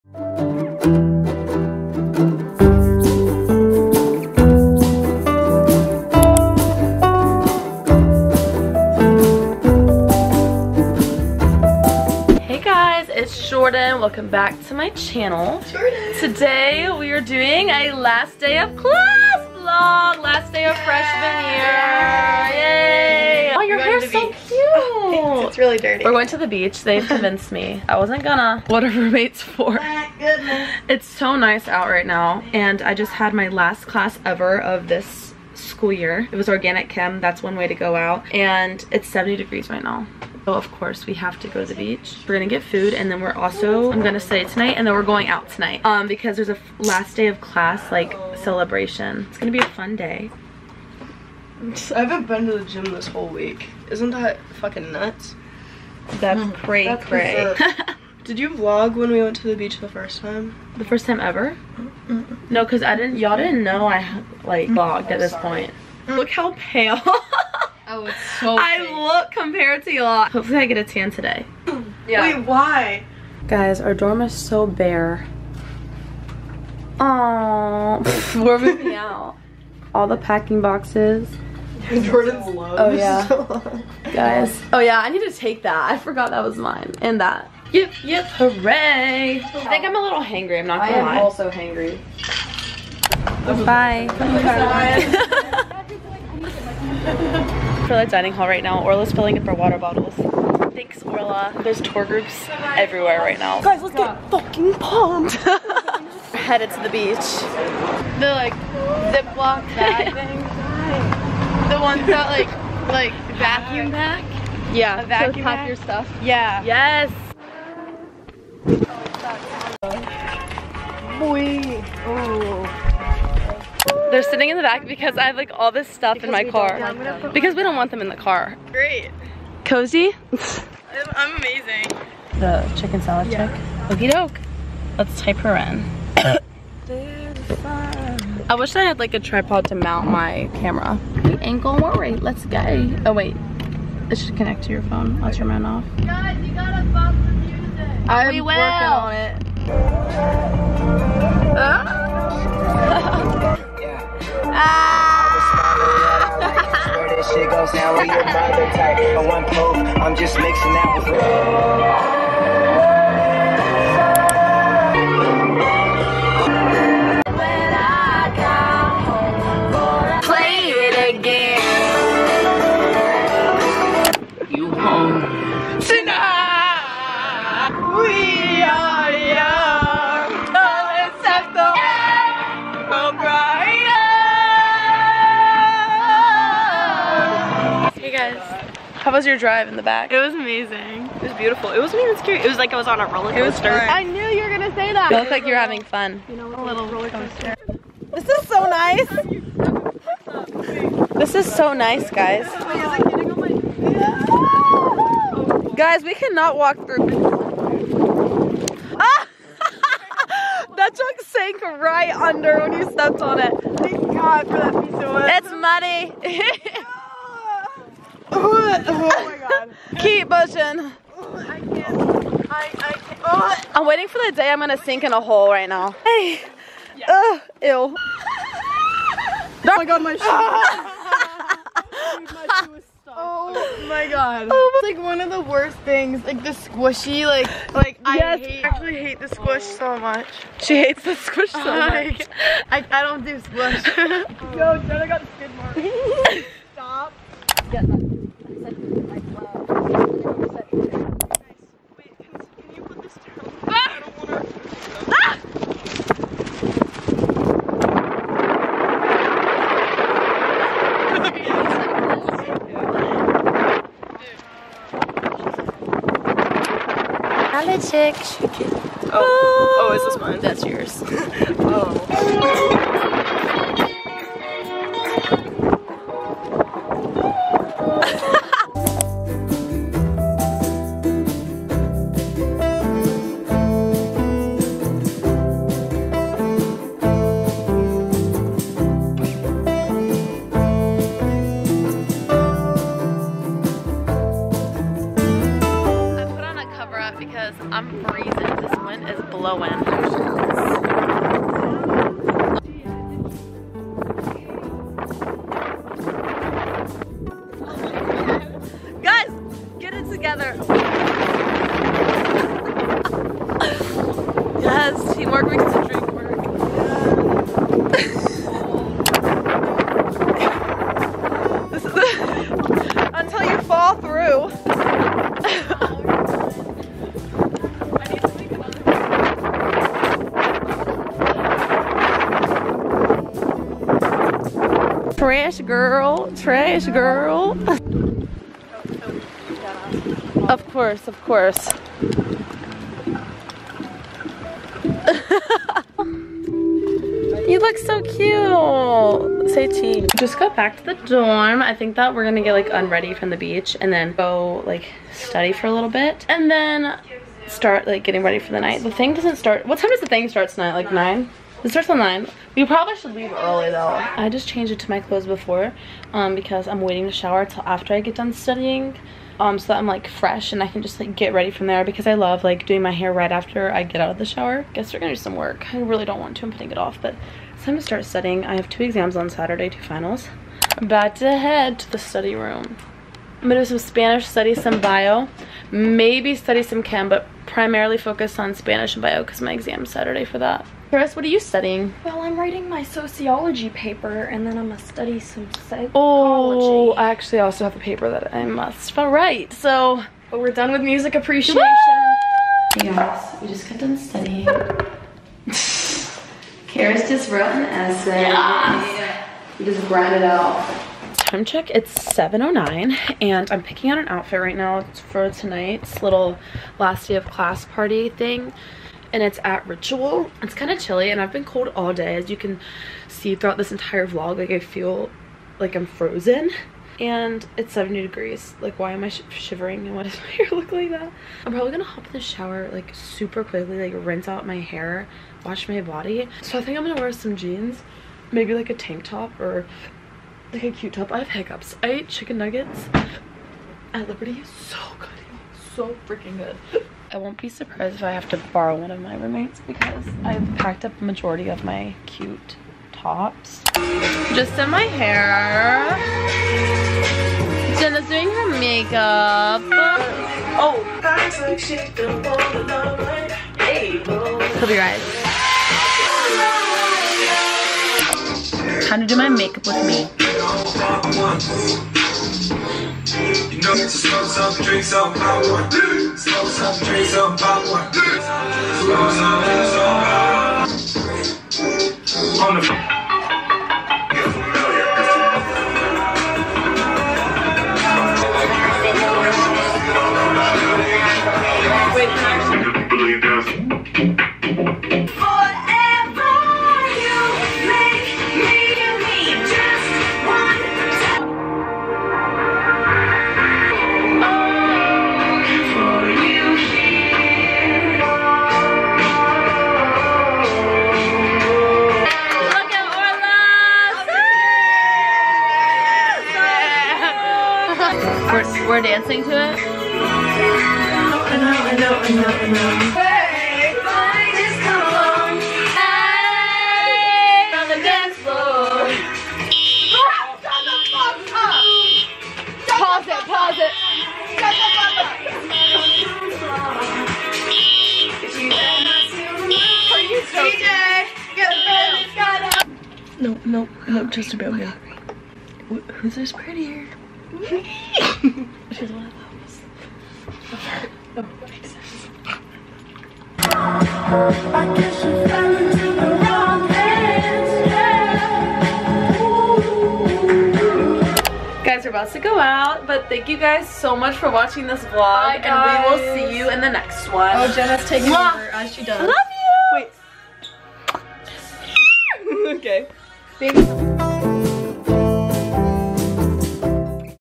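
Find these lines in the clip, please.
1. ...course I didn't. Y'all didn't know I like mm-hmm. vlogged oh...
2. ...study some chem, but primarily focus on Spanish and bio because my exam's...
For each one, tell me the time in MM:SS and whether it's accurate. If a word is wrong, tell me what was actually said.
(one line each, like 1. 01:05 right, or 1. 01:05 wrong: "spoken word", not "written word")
1. 01:02 wrong: "cause", not "course"
2. 06:26 right.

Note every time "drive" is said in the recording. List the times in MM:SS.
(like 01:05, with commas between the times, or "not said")
03:09.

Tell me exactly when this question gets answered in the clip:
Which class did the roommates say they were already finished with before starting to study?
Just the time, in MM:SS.
06:40.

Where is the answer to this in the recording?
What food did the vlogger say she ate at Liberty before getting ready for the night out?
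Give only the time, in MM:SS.
07:22.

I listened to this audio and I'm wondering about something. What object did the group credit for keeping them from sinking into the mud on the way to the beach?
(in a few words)
piece of wood.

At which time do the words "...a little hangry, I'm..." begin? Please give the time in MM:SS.
01:29.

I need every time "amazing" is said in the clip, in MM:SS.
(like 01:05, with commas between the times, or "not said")
02:11, 03:10.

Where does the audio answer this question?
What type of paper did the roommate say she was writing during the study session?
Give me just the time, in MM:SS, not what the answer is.
06:32.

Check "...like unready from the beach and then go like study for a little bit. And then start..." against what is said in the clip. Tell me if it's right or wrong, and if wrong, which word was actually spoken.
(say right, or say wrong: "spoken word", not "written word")
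right.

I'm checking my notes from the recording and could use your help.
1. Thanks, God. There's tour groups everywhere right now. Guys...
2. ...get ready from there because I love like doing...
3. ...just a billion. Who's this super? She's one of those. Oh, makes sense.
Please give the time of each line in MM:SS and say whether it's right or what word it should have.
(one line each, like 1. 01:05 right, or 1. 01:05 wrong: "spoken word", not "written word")
1. 01:40 wrong: "Orla", not "God"
2. 06:11 right
3. 09:04 wrong: "prettier", not "super".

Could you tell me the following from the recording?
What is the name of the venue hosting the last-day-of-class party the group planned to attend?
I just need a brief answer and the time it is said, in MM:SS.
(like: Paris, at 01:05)
Ritual, at 06:59.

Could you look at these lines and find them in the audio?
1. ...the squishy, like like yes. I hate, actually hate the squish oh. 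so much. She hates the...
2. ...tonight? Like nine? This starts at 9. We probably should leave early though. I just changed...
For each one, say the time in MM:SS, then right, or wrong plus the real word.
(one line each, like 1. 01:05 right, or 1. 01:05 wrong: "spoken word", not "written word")
1. 03:56 right
2. 06:00 right.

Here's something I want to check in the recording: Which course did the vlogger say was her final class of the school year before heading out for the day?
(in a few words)
Organic chem.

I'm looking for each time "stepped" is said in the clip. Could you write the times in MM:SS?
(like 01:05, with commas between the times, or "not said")
03:32.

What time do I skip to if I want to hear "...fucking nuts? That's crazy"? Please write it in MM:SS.
00:54.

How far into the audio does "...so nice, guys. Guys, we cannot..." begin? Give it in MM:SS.
03:21.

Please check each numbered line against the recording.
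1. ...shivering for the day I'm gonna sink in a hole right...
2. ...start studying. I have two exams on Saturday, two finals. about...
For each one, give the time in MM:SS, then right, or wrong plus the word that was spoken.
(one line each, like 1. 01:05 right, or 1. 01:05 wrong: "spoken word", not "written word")
1. 03:43 wrong: "waiting", not "shivering"
2. 06:17 right.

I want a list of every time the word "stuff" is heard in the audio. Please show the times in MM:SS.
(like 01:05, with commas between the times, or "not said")
01:55, 02:05.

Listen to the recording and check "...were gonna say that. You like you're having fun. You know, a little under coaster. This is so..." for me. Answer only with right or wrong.
wrong.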